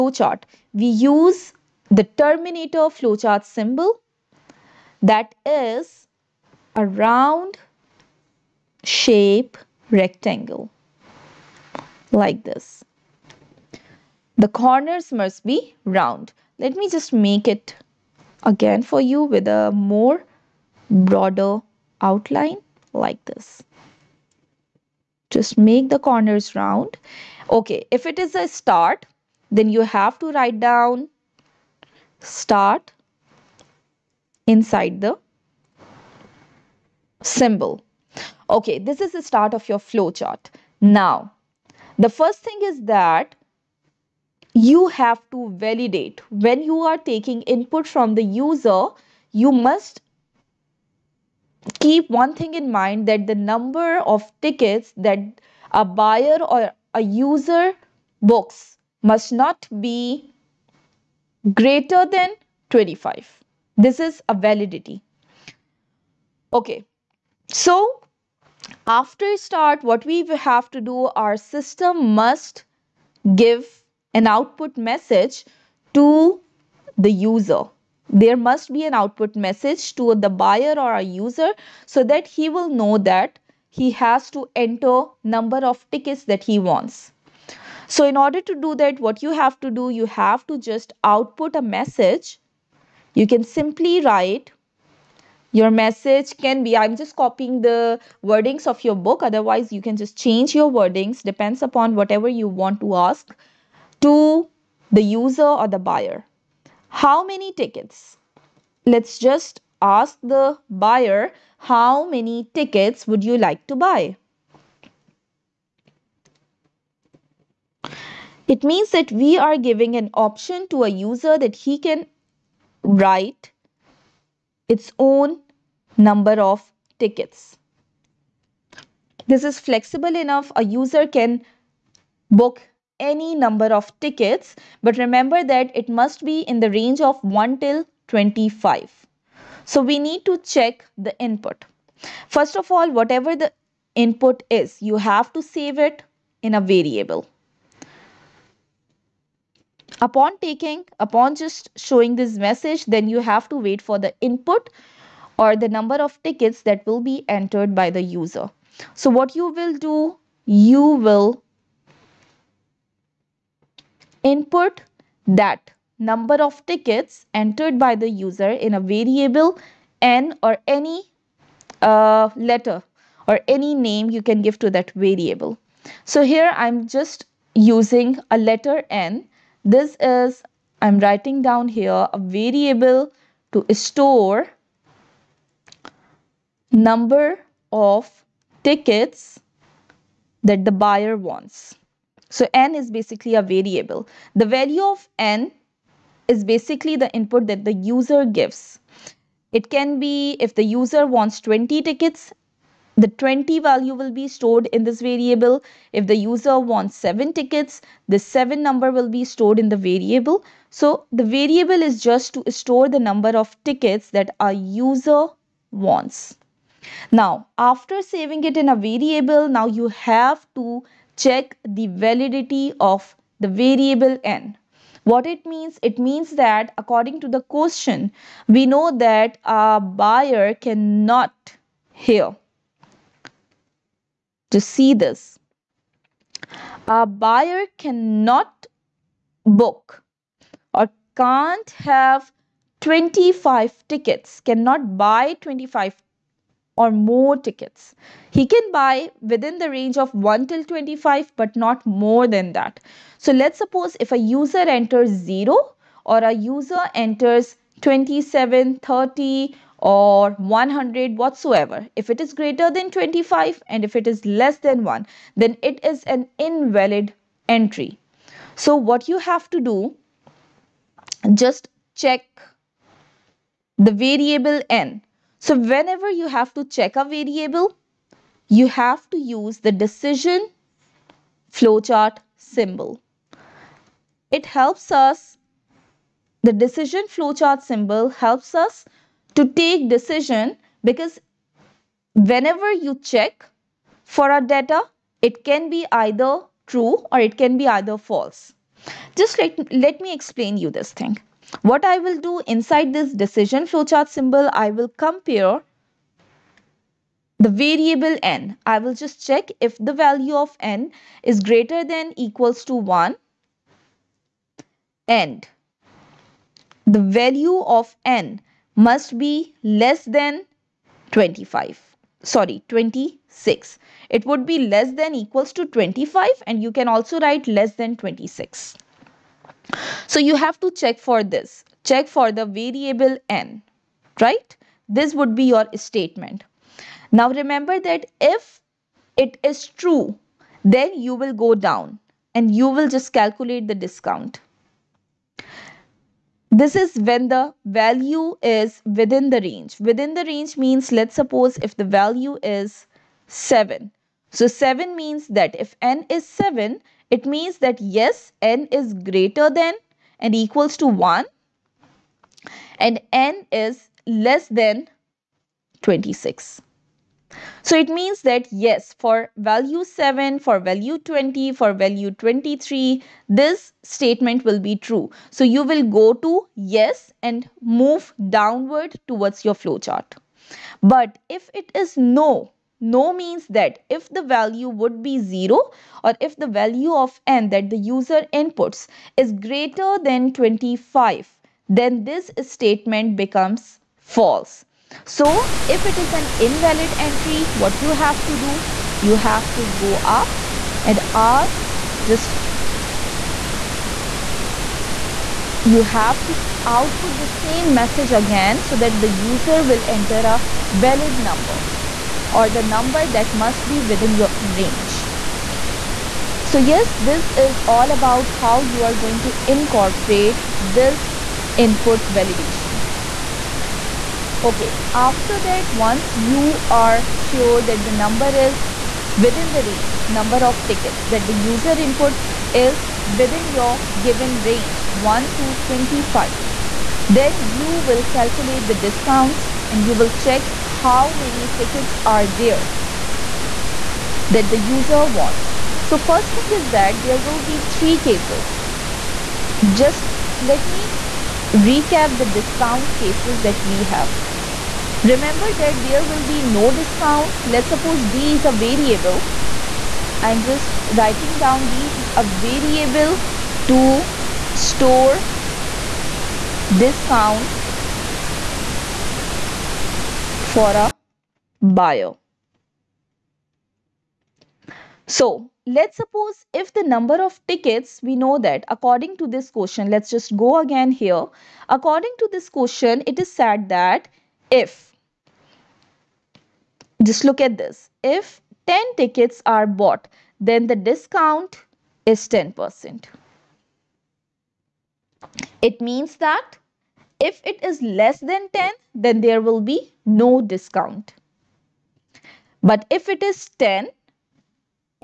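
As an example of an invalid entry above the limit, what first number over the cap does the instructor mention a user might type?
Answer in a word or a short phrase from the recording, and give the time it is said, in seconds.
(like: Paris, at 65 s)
27, at 257 s.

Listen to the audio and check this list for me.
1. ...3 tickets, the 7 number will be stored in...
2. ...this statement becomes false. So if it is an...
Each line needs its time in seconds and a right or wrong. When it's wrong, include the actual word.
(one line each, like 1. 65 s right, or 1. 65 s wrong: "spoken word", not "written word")
1. 206 s wrong: "7", not "3"
2. 392 s right.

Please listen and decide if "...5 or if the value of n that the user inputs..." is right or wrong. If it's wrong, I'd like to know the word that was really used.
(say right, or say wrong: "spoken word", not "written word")
wrong: "0", not "5".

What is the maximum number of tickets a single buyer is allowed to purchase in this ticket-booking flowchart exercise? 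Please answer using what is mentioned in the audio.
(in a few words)
25.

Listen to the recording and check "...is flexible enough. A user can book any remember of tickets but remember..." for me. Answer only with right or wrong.
wrong.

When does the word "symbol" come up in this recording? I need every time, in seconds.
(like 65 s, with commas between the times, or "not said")
3 s, 37 s, 282 s, 287 s, 304 s.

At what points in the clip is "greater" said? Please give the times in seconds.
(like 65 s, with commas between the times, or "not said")
61 s, 262 s, 311 s, 358 s, 389 s.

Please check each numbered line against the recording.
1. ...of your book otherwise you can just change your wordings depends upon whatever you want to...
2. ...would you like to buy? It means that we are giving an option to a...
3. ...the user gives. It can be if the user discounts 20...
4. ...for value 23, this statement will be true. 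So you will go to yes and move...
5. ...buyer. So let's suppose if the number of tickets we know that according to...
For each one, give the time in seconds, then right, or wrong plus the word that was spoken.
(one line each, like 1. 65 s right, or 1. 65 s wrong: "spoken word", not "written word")
1. 98 s right
2. 113 s right
3. 197 s wrong: "wants", not "discounts"
4. 371 s right
5. 471 s right.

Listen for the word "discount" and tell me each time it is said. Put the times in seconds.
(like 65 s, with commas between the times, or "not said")
343 s, 438 s, 452 s, 456 s, 466 s, 490 s, 500 s.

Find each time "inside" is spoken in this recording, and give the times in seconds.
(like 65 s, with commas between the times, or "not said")
34 s, 302 s.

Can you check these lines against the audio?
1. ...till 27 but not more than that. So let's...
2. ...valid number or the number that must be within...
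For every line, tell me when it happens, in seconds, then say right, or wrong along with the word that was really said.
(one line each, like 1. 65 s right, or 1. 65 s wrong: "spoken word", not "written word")
1. 250 s wrong: "25", not "27"
2. 410 s right.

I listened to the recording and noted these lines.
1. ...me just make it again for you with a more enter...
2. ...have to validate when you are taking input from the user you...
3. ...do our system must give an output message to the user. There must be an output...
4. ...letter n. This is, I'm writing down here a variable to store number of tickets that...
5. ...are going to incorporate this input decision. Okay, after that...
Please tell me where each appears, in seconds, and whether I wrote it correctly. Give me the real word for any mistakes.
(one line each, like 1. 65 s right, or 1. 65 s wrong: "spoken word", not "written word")
1. 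16 s wrong: "broader", not "enter"
2. 44 s right
3. 70 s right
4. 178 s right
5. 418 s wrong: "validation", not "decision".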